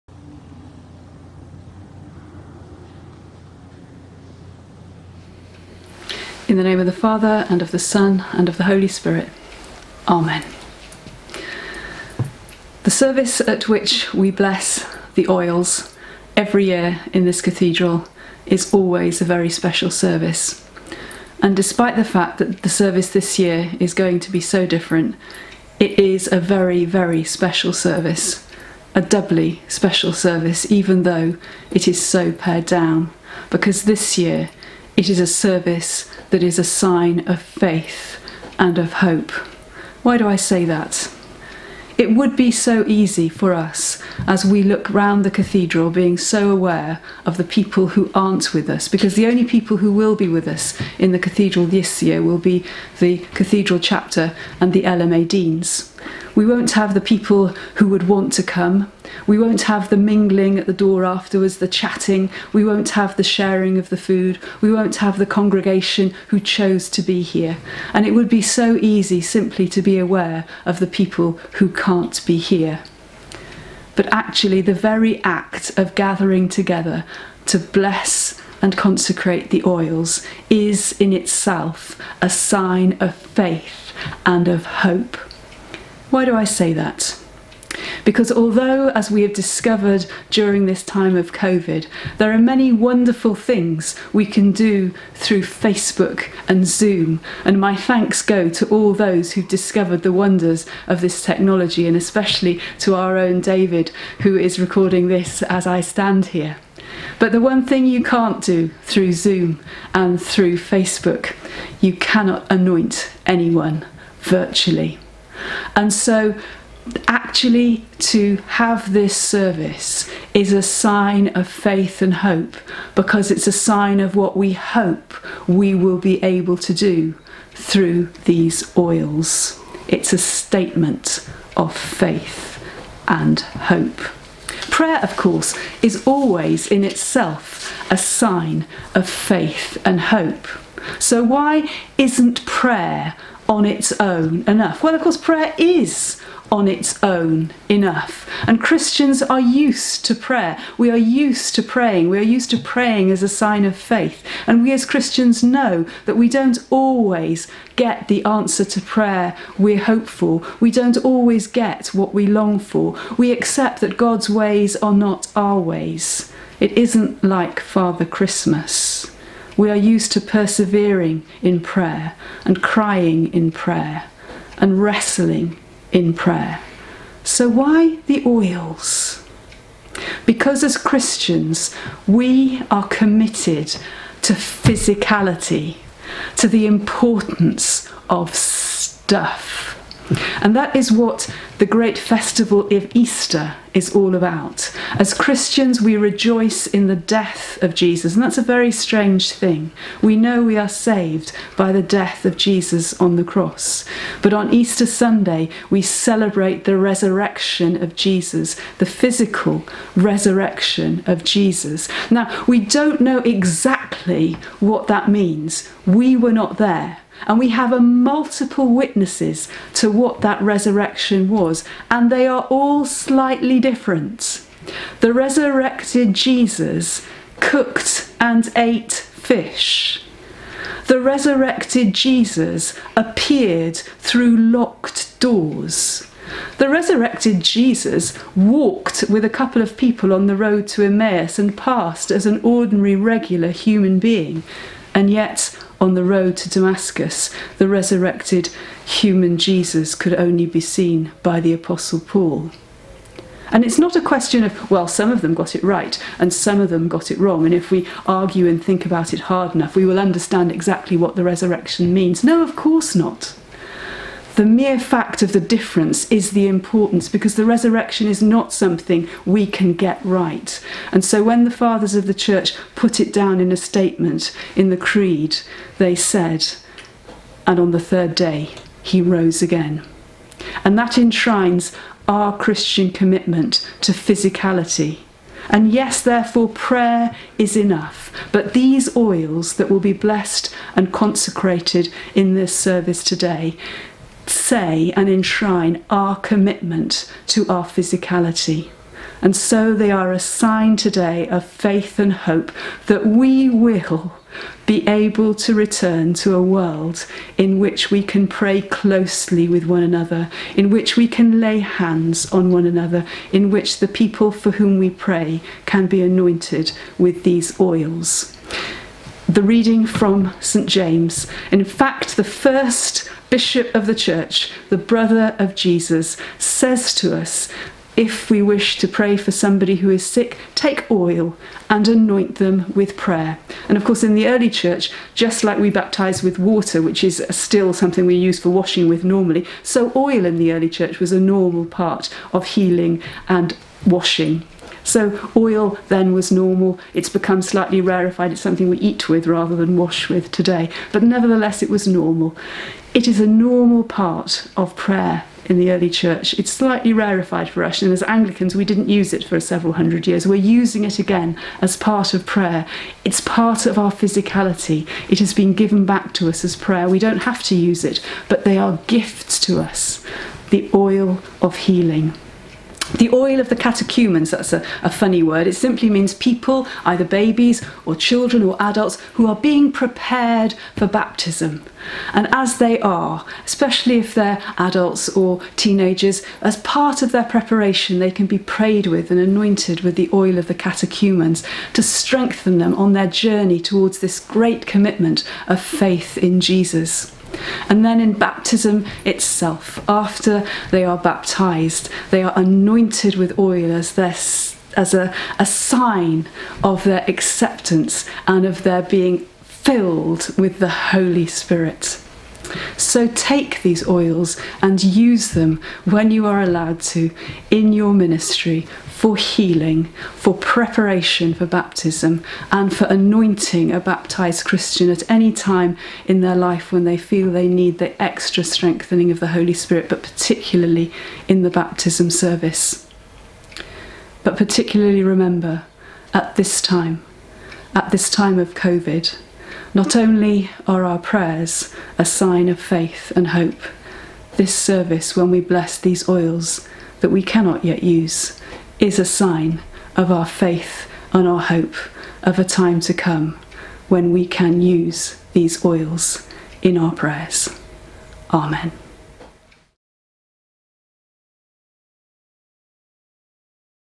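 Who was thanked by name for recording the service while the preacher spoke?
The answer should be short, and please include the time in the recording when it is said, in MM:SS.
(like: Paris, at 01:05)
David, at 01:43.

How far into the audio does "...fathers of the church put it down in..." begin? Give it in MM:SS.
04:31.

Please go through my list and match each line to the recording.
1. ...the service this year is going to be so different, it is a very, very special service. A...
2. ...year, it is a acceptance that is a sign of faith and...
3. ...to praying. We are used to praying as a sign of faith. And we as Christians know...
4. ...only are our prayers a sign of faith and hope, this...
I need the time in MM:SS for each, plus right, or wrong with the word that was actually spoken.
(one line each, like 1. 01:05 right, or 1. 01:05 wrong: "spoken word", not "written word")
1. 00:22 right
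2. 00:34 wrong: "service", not "acceptance"
3. 02:31 right
4. 07:19 right.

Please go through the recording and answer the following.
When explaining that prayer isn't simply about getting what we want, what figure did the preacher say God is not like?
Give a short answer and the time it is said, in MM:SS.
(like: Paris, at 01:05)
Father Christmas, at 02:47.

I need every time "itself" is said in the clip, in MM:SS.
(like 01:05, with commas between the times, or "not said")
01:21, 02:16, 06:39.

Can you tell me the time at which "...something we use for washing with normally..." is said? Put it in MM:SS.
05:37.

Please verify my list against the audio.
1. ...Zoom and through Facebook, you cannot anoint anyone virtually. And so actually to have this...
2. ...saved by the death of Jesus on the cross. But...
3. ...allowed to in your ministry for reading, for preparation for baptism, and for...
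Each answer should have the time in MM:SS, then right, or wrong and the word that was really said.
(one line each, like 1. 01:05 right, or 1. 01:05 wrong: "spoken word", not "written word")
1. 01:49 right
2. 03:20 right
3. 06:56 wrong: "healing", not "reading".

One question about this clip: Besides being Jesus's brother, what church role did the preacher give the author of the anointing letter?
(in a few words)
First bishop.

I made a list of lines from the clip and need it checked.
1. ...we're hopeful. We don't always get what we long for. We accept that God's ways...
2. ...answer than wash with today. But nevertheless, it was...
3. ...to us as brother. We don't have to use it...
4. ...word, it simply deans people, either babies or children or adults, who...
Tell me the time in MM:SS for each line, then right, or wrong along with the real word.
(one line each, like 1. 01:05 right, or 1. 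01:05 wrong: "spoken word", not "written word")
1. 02:39 right
2. 05:49 wrong: "rather", not "answer"
3. 06:06 wrong: "prayer", not "brother"
4. 06:15 wrong: "means", not "deans".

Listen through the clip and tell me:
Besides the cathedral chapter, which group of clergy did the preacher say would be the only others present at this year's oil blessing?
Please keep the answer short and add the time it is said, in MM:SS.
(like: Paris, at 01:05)
LMA deans, at 00:54.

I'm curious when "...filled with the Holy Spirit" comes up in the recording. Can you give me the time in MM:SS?
06:49.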